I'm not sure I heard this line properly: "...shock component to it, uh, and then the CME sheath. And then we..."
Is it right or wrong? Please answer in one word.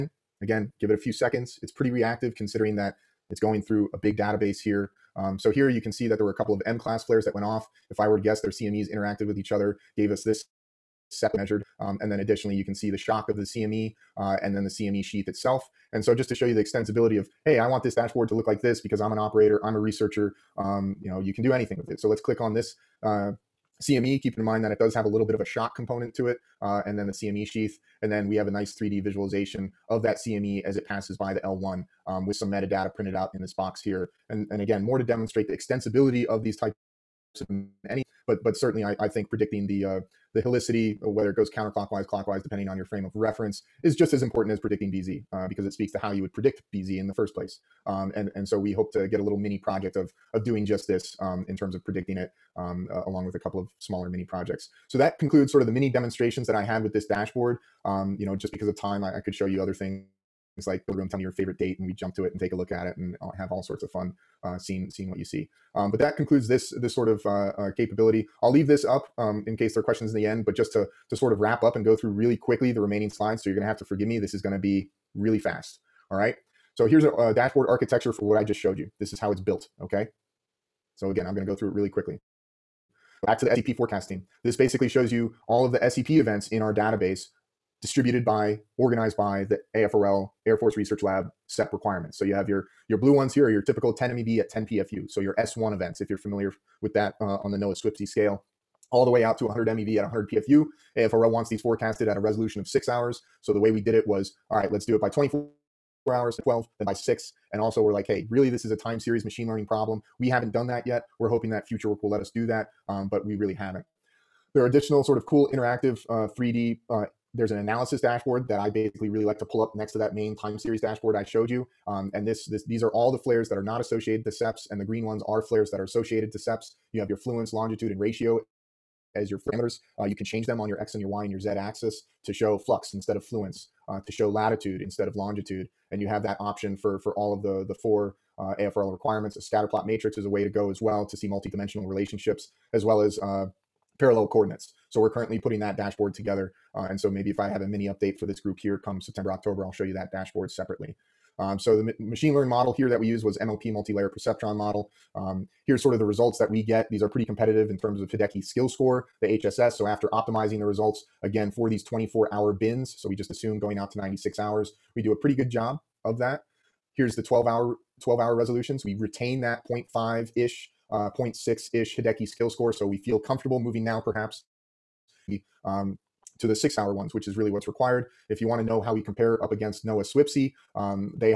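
right.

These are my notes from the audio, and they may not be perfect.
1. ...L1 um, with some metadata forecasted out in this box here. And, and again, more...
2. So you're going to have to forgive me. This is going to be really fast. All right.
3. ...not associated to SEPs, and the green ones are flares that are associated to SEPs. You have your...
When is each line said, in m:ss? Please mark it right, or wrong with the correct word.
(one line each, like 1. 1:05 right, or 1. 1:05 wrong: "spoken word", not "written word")
1. 0:31 wrong: "printed", not "forecasted"
2. 1:13 right
3. 2:03 right.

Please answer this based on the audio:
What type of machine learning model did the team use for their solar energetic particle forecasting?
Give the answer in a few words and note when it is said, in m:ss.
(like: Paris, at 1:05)
Multi-layer perceptron, at 2:33.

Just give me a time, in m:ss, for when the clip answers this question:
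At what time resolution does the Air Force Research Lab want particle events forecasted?
1:42.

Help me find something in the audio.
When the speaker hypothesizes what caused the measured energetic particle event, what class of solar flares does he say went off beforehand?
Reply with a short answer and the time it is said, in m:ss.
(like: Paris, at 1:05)
M class, at 0:06.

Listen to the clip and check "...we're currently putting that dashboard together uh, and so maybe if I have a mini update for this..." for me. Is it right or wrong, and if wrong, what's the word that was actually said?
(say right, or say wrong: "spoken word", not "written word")
right.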